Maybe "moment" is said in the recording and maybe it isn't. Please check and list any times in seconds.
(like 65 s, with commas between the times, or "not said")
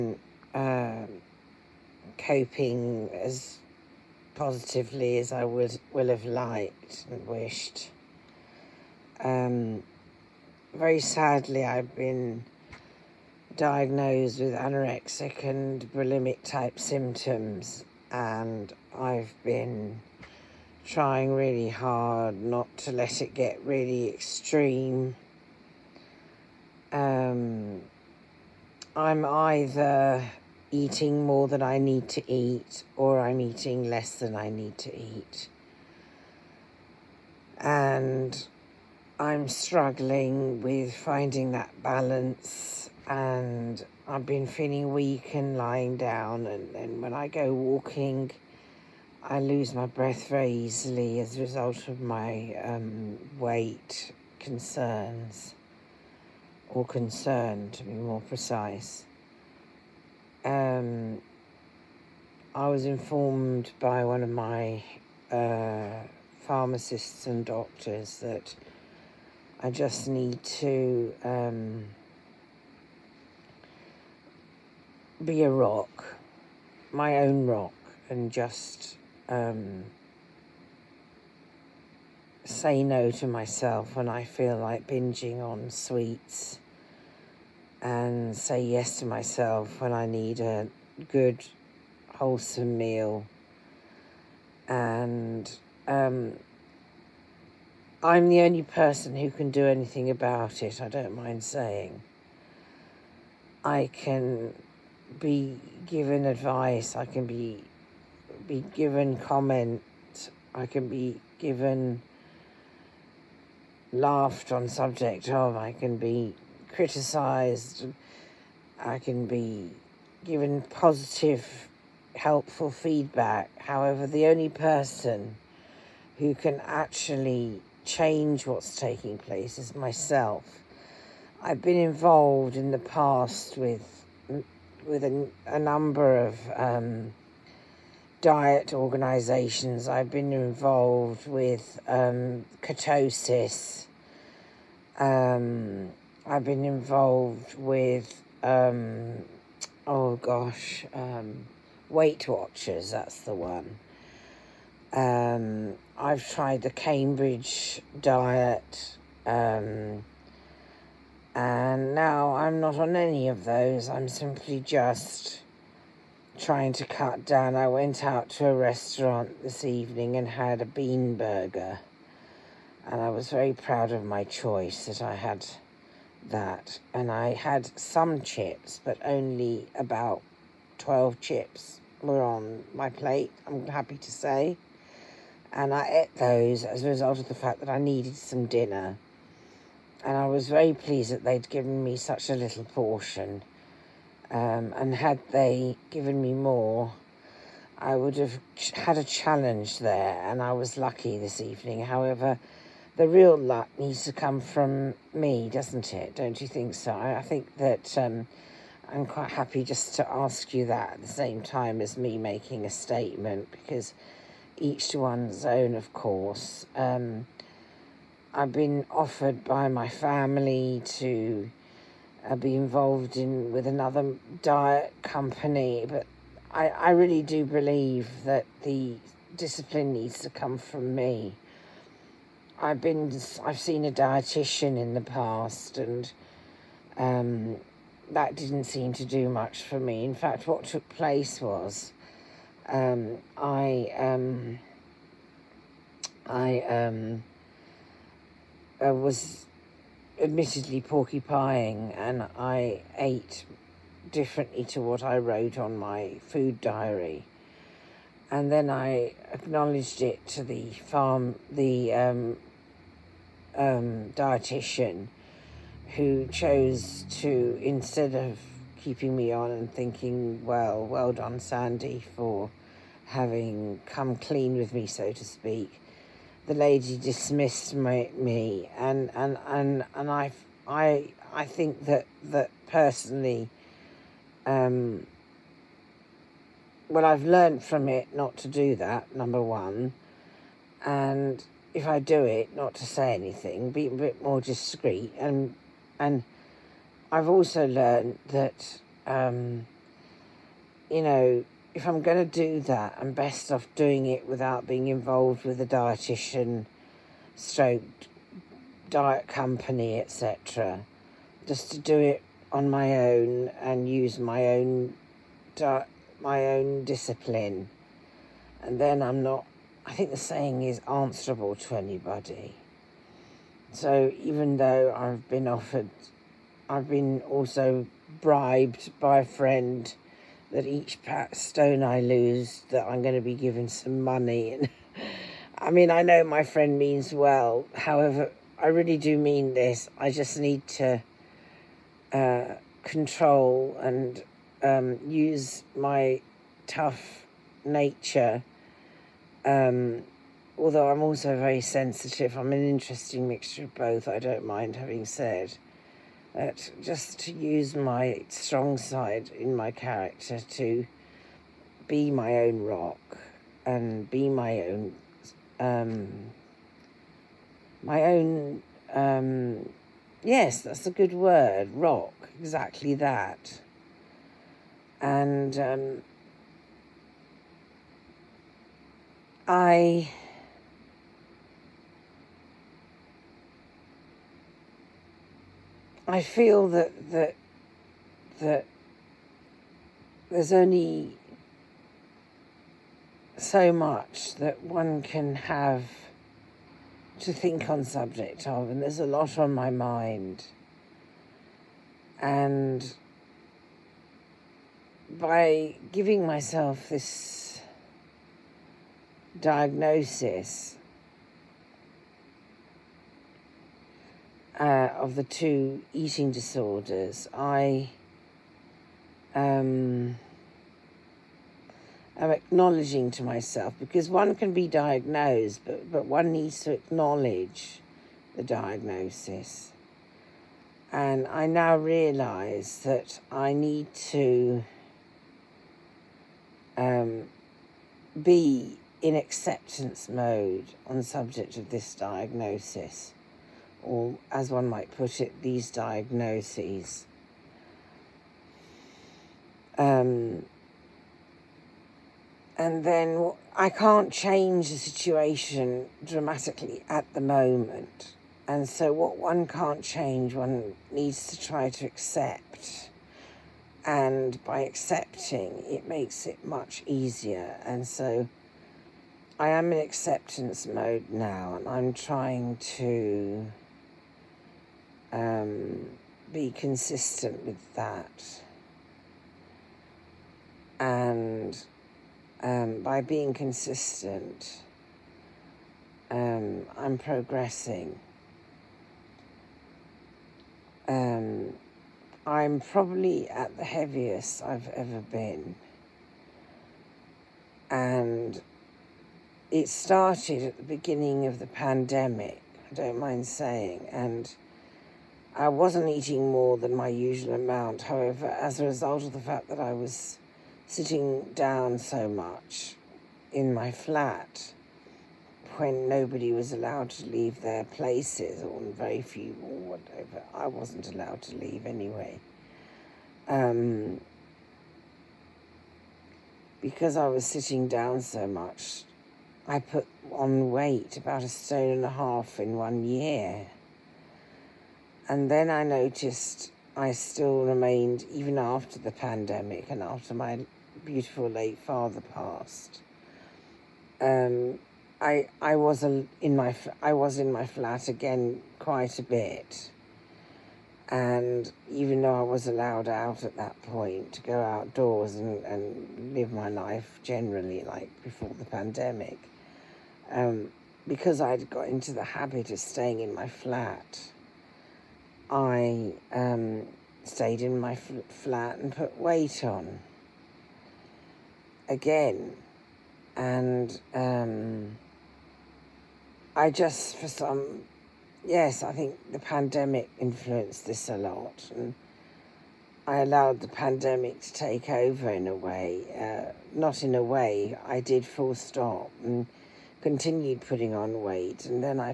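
457 s.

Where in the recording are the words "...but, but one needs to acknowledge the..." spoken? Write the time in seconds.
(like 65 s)
425 s.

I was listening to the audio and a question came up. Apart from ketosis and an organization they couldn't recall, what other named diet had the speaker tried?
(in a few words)
Cambridge diet.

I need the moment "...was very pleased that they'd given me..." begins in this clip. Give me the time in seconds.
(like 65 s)
190 s.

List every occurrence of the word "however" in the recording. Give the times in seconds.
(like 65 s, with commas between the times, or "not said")
123 s, 201 s, 337 s, 507 s.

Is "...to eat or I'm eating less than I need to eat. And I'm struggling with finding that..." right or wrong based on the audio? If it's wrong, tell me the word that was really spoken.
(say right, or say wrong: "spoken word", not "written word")
right.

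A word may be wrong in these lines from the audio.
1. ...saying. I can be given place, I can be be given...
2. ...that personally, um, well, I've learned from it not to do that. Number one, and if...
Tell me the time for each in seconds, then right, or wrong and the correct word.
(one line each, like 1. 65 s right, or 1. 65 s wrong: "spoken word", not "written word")
1. 101 s wrong: "advice", not "place"
2. 282 s right.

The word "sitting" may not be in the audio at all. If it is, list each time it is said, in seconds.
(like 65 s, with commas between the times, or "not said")
510 s, 527 s.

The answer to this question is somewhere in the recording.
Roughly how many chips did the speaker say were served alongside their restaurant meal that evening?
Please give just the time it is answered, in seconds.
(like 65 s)
180 s.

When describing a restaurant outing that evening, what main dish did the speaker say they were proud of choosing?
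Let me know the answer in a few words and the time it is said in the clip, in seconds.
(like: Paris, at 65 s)
bean burger, at 170 s.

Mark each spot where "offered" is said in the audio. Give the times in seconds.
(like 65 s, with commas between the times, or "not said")
218 s, 325 s.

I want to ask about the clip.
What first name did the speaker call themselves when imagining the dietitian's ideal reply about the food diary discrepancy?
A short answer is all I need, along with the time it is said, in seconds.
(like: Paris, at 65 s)
Sandy, at 271 s.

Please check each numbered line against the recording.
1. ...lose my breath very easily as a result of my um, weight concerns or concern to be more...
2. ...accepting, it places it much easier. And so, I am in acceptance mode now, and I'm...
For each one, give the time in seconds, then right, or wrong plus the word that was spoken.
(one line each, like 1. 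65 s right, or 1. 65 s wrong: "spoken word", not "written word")
1. 49 s right
2. 464 s wrong: "makes", not "places".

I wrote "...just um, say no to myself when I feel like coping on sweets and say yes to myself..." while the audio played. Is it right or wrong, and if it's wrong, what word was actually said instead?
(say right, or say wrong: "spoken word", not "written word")
wrong: "binging", not "coping".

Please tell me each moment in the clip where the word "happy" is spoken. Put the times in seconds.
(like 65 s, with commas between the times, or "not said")
183 s, 209 s.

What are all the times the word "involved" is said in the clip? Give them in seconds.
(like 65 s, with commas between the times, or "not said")
131 s, 140 s, 146 s, 222 s, 304 s.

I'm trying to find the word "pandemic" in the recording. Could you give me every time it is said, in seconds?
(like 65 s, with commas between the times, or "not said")
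501 s, 538 s, 558 s, 579 s, 583 s.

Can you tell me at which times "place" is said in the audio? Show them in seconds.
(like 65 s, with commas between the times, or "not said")
129 s, 240 s, 517 s.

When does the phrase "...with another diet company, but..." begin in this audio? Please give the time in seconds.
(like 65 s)
223 s.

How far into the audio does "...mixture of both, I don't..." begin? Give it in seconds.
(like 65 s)
353 s.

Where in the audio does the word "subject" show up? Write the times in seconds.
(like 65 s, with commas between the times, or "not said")
114 s, 397 s, 441 s.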